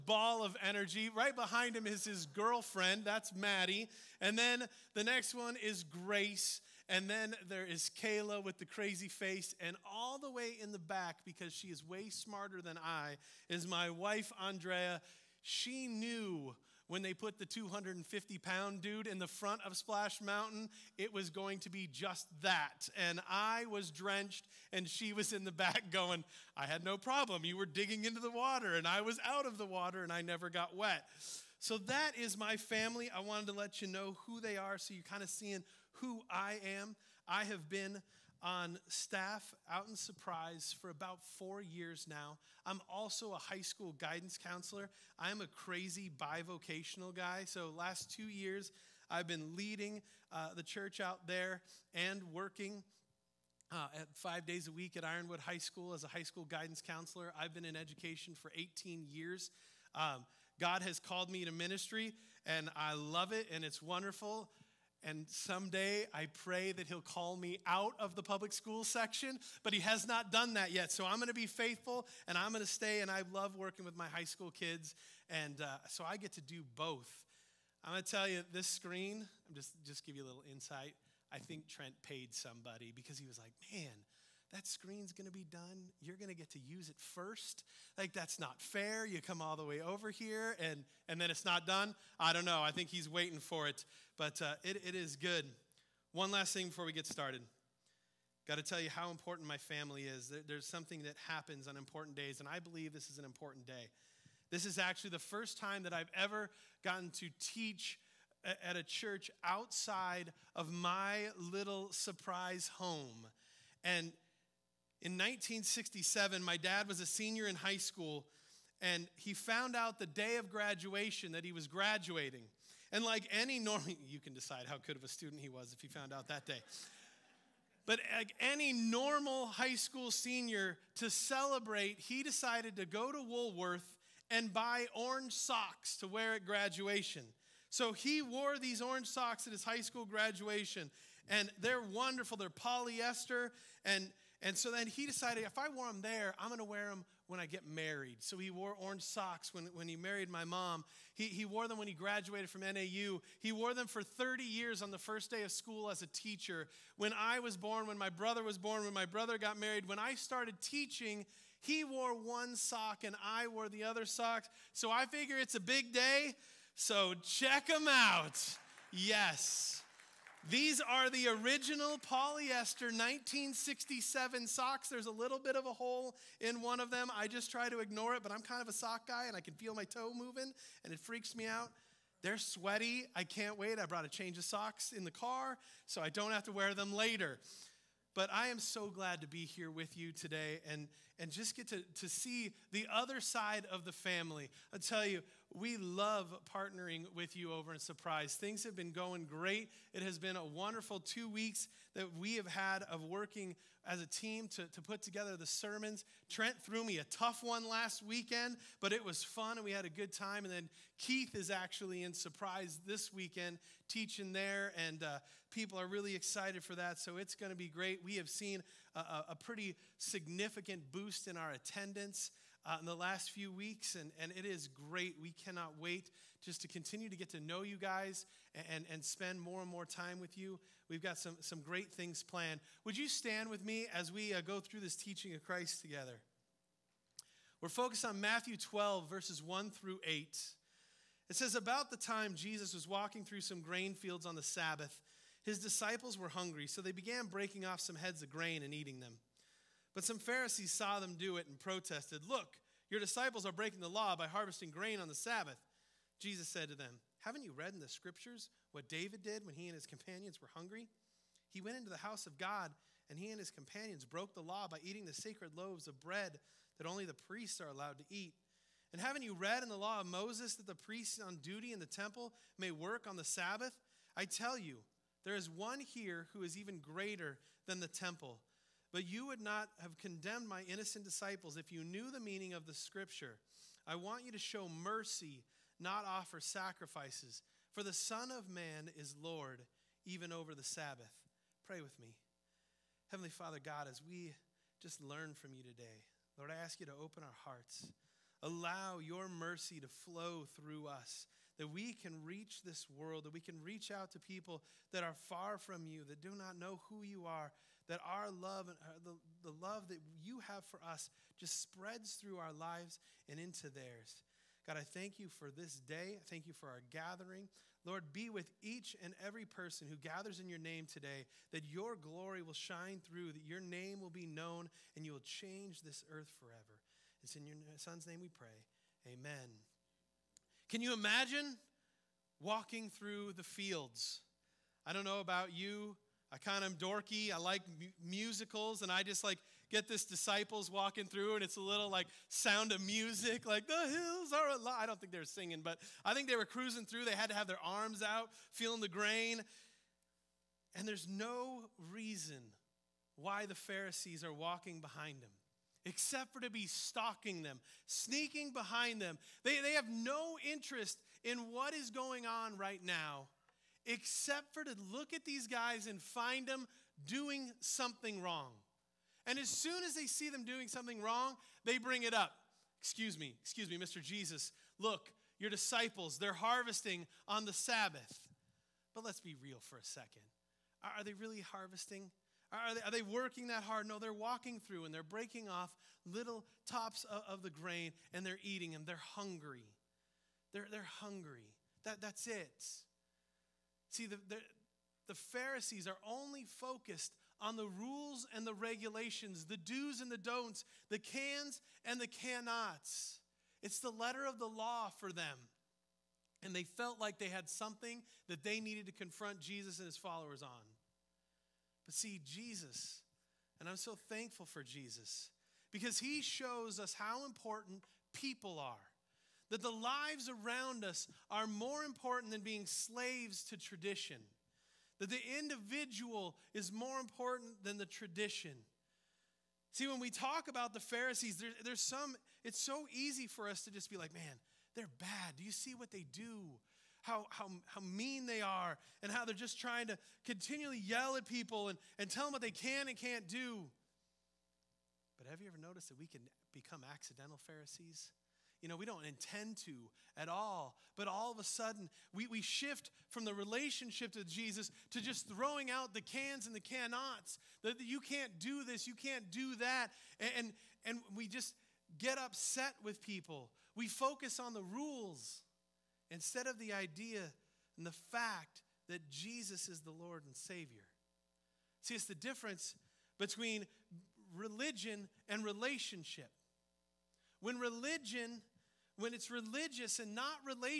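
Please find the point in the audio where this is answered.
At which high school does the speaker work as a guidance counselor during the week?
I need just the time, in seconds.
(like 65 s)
55 s.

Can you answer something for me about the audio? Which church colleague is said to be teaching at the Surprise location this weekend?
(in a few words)
Keith.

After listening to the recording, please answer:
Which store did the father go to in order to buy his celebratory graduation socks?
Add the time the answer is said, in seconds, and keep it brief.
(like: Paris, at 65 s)
Woolworth, at 133 s.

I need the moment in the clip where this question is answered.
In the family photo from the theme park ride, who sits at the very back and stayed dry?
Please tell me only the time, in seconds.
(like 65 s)
14 s.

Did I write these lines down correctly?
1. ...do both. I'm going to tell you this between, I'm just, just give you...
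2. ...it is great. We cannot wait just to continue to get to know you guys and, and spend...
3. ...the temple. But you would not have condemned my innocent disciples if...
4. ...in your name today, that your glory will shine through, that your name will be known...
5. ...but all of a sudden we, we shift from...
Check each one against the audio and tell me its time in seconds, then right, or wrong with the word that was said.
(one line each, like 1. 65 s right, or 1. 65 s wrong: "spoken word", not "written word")
1. 76 s wrong: "screen", not "between"
2. 224 s right
3. 277 s right
4. 320 s right
5. 450 s right.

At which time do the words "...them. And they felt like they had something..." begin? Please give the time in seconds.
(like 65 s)
405 s.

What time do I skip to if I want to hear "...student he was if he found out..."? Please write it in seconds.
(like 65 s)
125 s.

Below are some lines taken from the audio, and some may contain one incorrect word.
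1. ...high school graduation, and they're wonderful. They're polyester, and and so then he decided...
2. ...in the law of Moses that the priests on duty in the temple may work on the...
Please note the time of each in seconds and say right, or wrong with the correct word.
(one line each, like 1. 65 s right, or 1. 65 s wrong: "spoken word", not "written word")
1. 139 s right
2. 269 s right.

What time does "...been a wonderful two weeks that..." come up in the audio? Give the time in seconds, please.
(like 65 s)
200 s.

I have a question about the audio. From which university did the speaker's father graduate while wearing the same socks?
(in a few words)
NAU.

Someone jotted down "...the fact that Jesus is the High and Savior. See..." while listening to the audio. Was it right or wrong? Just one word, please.
wrong.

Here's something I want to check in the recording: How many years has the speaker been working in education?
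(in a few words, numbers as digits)
18.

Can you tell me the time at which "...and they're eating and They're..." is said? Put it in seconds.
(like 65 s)
388 s.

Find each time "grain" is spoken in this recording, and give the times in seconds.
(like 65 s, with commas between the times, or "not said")
243 s, 248 s, 254 s, 348 s, 387 s.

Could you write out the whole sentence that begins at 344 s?
I don't think they were singing, but I think they were cruising through.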